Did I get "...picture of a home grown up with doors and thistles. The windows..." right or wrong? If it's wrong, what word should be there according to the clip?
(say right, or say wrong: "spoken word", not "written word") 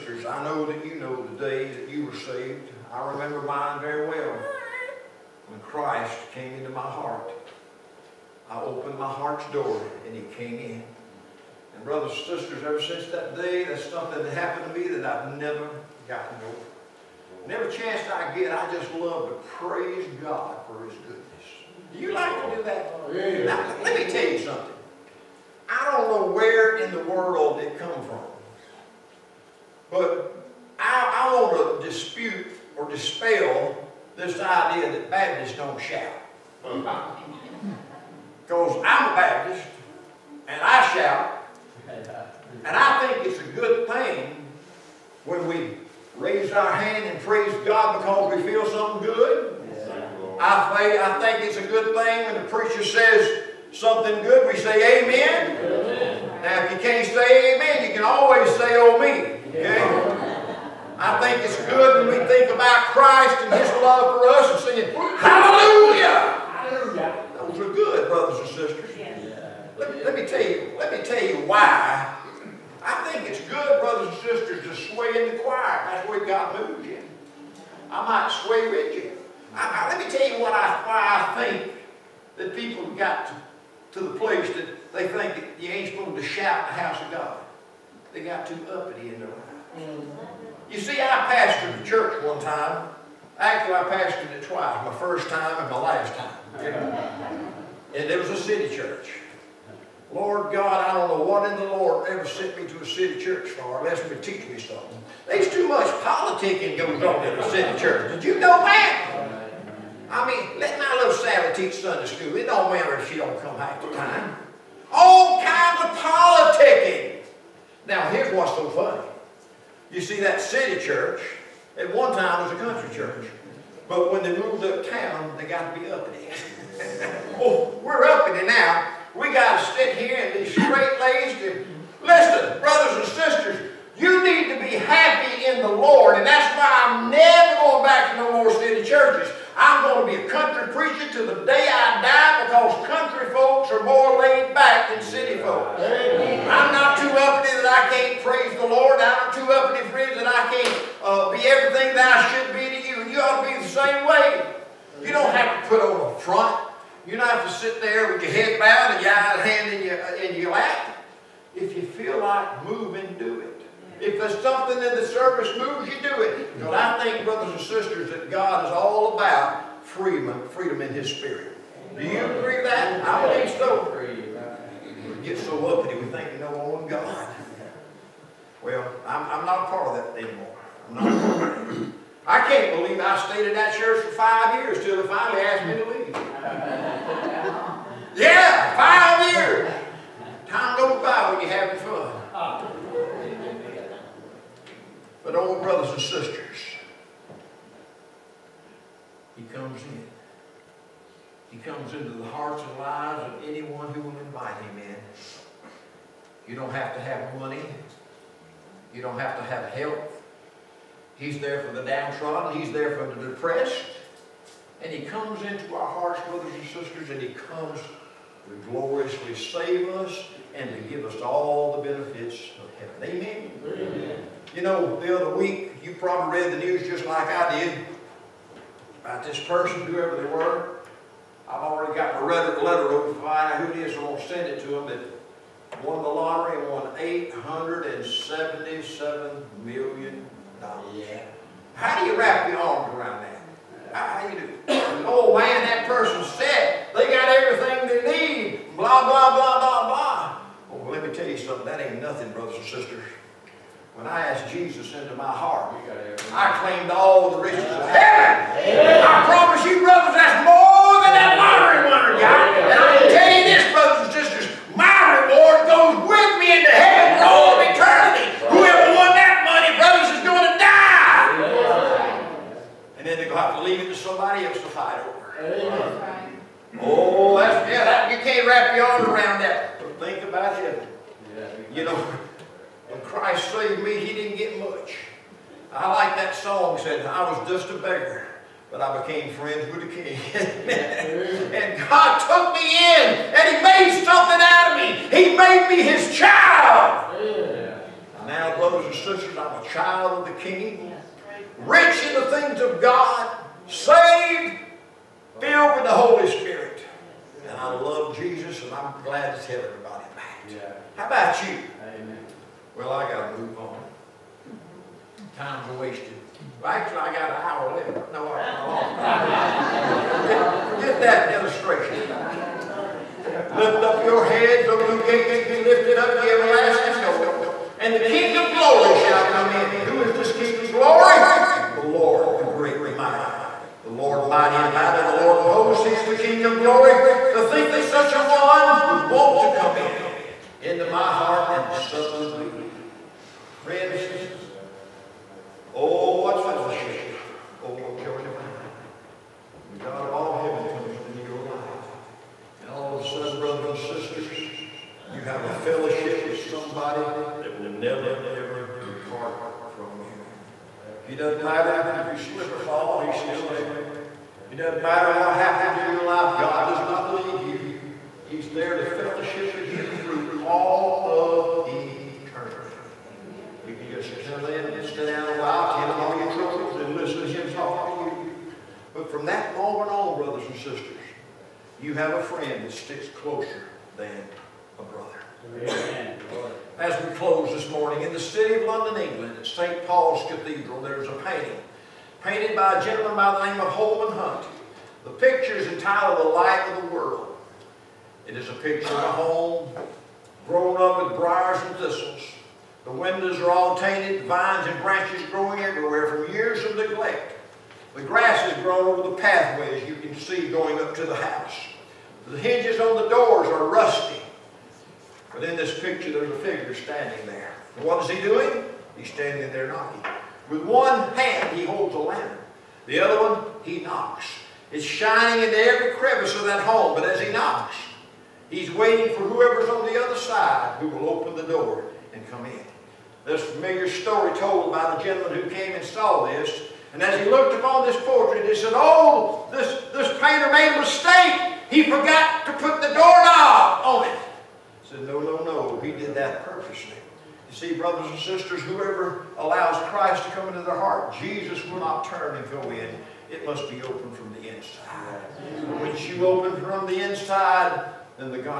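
wrong: "briars", not "doors".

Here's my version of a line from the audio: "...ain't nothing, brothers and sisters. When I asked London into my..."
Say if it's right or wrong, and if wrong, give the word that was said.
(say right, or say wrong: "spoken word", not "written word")
wrong: "Jesus", not "London".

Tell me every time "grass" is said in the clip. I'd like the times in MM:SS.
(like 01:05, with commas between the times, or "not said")
06:48.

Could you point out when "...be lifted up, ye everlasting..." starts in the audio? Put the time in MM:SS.
05:25.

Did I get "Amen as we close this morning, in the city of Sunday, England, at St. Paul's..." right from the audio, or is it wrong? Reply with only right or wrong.
wrong.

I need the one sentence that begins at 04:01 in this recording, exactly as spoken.
How do you wrap your arms around that?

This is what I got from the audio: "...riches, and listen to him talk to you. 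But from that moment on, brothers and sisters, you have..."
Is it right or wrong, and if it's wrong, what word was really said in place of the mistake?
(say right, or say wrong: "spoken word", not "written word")
wrong: "troubles", not "riches".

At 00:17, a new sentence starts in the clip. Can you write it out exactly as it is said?
every chance I get, I just love to praise God for his goodness.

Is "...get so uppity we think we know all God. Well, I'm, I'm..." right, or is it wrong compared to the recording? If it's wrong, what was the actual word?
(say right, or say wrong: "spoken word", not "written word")
right.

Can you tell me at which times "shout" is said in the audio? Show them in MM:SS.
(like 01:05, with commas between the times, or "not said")
00:35, 00:40, 01:26.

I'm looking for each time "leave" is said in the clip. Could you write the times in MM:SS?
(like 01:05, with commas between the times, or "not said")
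03:05, 06:07.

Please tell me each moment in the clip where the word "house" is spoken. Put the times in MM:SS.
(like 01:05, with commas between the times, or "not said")
01:26, 06:51.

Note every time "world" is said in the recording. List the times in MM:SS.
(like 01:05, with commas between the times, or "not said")
00:27, 06:36.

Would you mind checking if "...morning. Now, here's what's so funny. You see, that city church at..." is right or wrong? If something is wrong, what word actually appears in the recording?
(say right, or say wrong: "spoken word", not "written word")
wrong: "politicking", not "morning".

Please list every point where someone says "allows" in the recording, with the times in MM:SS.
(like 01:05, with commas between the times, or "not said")
07:29.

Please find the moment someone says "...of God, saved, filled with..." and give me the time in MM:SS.
05:02.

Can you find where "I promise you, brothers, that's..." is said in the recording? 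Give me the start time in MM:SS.
04:19.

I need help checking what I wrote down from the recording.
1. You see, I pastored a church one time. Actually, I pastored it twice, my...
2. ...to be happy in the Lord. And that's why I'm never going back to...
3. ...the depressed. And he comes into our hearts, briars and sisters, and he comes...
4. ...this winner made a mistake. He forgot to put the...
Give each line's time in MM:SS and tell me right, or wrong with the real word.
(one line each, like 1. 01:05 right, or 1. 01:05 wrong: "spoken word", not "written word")
1. 01:30 right
2. 02:14 right
3. 03:33 wrong: "brothers", not "briars"
4. 07:19 wrong: "painter", not "winner".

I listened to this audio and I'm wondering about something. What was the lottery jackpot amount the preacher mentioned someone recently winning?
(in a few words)
$877 million.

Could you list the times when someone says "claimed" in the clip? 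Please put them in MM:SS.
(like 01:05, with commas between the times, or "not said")
04:16.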